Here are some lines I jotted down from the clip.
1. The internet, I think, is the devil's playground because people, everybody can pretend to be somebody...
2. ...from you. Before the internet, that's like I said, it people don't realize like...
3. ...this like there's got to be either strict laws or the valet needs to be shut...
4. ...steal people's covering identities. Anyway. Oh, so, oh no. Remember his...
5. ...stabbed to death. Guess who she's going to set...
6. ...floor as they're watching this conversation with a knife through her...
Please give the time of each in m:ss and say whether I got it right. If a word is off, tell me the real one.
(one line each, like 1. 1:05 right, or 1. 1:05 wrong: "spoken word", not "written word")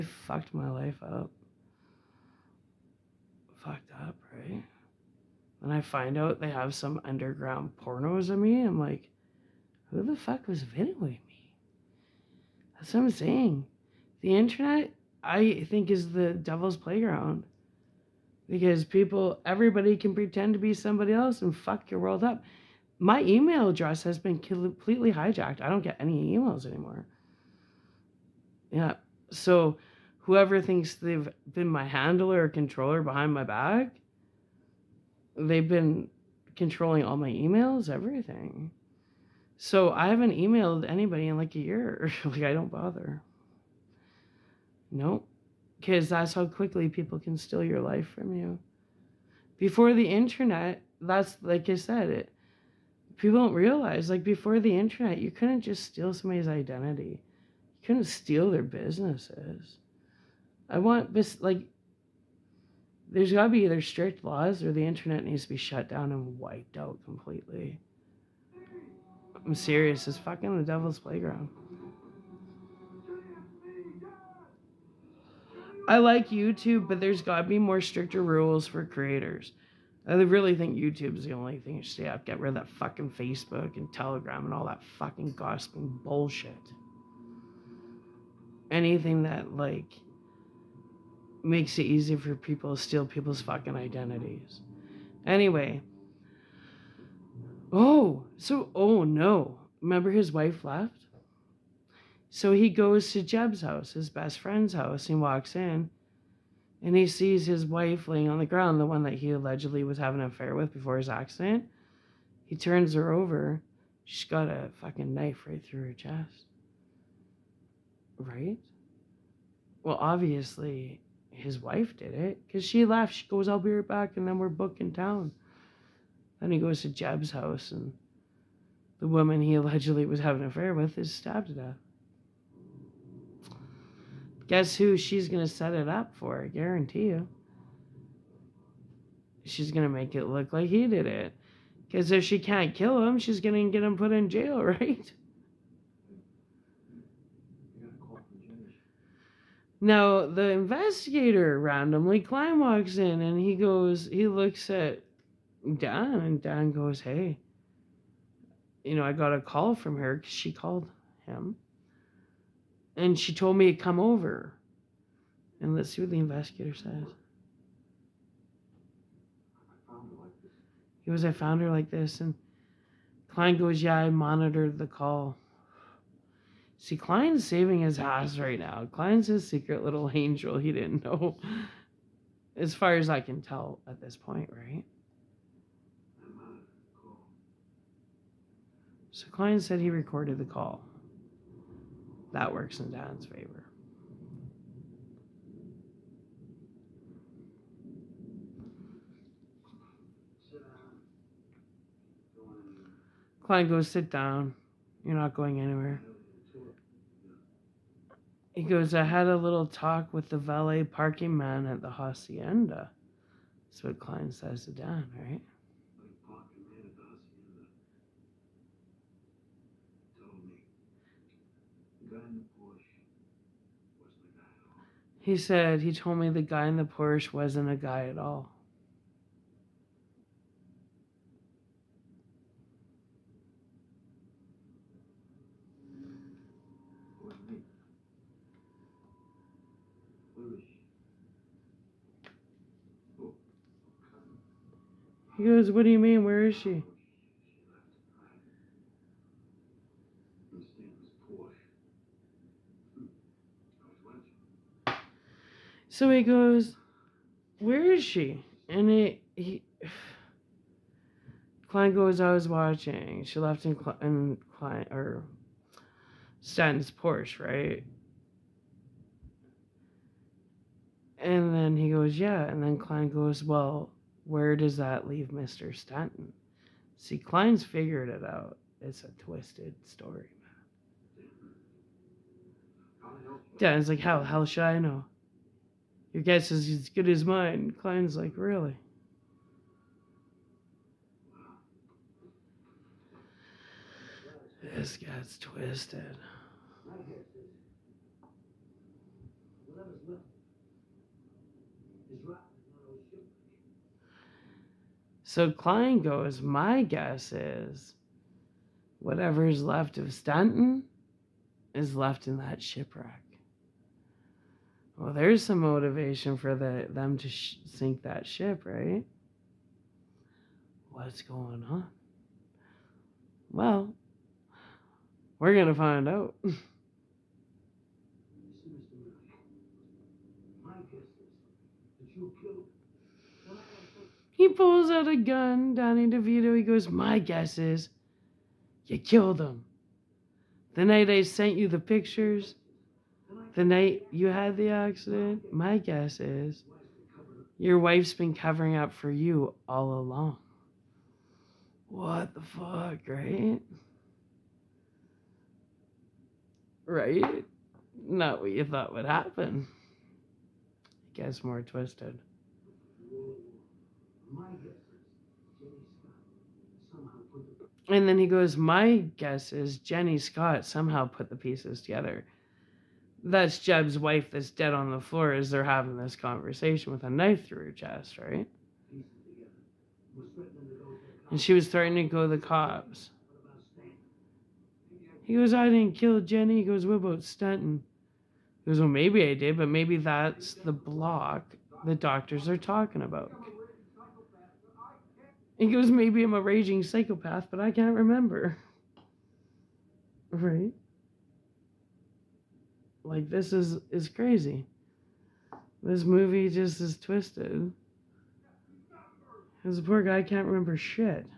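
1. 0:14 right
2. 0:48 right
3. 1:01 wrong: "internet", not "valet"
4. 1:32 wrong: "fucking", not "covering"
5. 2:11 right
6. 6:15 wrong: "having", not "watching".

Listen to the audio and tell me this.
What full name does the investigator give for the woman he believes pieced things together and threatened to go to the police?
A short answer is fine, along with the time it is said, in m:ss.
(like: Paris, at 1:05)
Jenny Scott, at 6:09.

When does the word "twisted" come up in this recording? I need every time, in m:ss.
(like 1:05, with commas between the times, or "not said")
4:39, 4:55, 6:01, 6:46.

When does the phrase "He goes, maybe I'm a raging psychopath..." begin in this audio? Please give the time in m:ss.
6:35.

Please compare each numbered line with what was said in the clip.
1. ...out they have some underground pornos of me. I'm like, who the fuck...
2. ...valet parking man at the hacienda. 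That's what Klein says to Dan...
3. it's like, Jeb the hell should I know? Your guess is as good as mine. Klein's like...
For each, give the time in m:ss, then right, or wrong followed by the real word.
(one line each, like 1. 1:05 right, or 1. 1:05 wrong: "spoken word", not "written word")
1. 0:06 right
2. 3:30 right
3. 4:43 wrong: "How", not "Jeb".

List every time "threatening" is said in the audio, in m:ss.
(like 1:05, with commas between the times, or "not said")
6:21.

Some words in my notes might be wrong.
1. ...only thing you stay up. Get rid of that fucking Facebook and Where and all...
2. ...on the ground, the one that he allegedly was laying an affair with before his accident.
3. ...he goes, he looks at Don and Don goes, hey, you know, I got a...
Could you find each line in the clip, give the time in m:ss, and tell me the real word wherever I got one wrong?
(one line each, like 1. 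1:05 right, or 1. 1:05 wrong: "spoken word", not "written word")
1. 1:21 wrong: "Telegram", not "Where"
2. 1:48 wrong: "having", not "laying"
3. 2:33 right.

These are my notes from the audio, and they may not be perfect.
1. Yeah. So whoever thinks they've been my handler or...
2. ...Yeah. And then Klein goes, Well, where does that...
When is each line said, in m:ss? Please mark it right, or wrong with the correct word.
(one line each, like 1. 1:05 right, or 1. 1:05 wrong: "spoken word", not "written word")
1. 0:28 right
2. 4:32 right.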